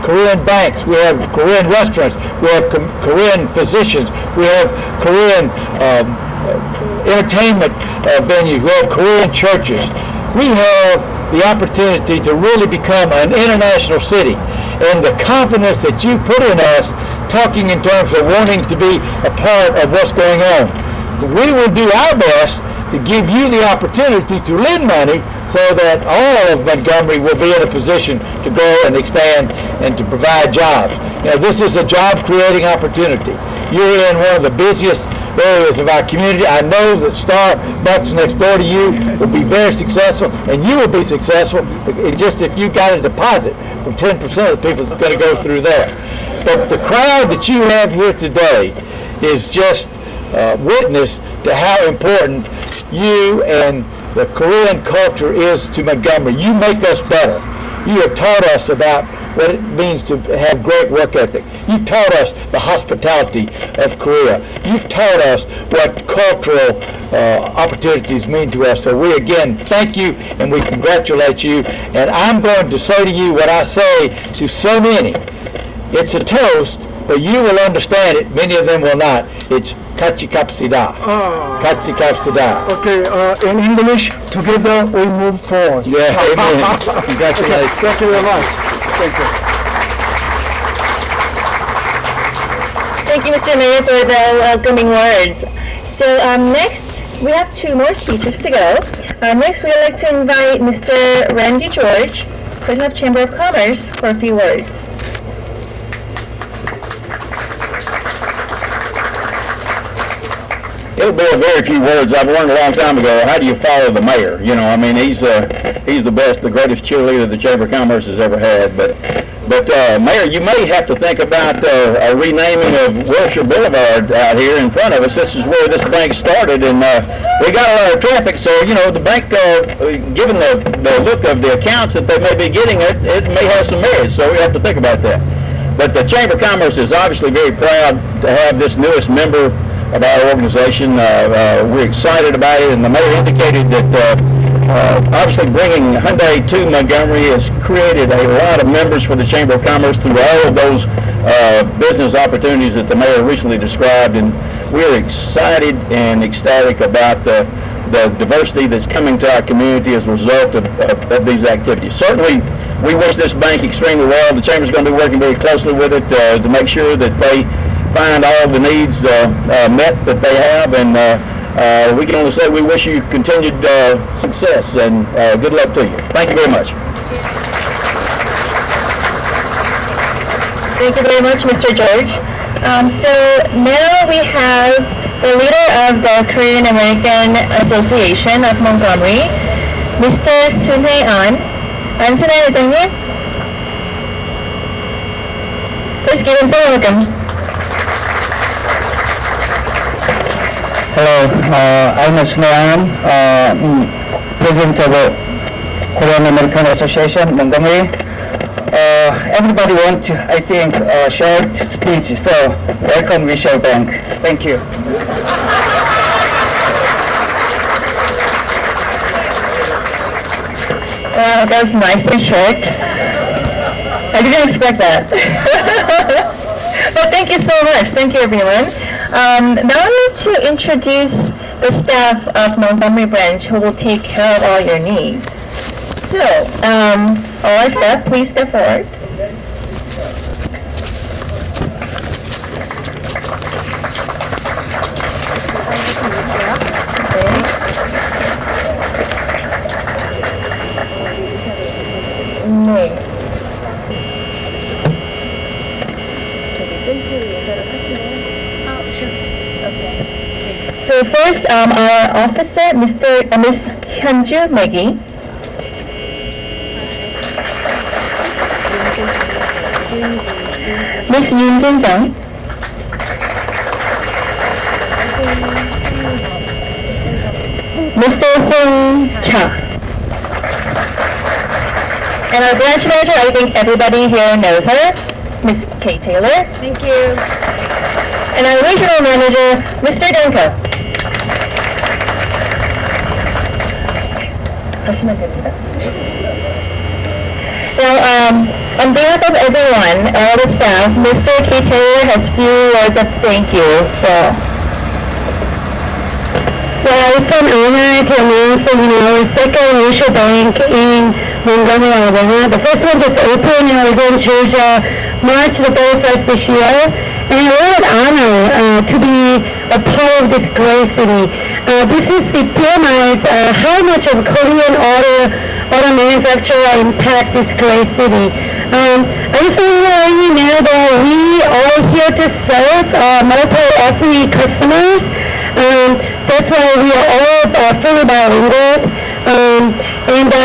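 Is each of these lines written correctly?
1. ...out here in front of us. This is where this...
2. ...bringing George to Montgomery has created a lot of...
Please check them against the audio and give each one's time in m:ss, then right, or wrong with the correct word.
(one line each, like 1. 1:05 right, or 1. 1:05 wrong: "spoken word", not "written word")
1. 2:04 right
2. 2:25 wrong: "Hyundai", not "George".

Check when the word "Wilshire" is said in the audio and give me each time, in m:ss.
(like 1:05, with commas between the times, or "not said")
2:03, 3:33.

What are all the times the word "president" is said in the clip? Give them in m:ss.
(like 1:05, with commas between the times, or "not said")
1:42, 3:24.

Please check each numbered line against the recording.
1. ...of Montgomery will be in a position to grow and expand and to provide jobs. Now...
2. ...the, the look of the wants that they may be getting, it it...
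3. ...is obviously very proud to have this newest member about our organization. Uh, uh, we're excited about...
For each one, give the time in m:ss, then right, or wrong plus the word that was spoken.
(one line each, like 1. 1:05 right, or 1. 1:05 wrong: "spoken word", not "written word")
1. 0:26 right
2. 2:10 wrong: "accounts", not "wants"
3. 2:16 right.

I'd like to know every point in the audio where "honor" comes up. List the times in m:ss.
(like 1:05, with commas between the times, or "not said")
5:07, 5:17.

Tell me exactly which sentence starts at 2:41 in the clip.
Certainly, we wish this bank extremely well.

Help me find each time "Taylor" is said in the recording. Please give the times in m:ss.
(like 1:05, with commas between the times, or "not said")
4:45, 5:01.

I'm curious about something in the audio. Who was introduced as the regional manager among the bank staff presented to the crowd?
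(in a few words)
Dan Ko.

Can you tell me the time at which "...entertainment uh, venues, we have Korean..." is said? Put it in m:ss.
0:07.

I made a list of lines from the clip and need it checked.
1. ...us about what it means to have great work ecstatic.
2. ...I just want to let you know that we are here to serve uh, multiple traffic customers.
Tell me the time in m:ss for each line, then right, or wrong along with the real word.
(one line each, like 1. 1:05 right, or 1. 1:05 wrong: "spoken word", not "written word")
1. 0:58 wrong: "ethic", not "ecstatic"
2. 5:29 wrong: "ethnic", not "traffic".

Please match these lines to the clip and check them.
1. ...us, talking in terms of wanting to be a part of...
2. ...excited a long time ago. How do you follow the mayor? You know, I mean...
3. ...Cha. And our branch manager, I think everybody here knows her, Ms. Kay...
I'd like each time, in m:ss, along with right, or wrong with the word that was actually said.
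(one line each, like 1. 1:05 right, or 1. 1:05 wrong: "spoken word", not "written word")
1. 0:16 right
2. 1:52 wrong: "learned", not "excited"
3. 4:39 right.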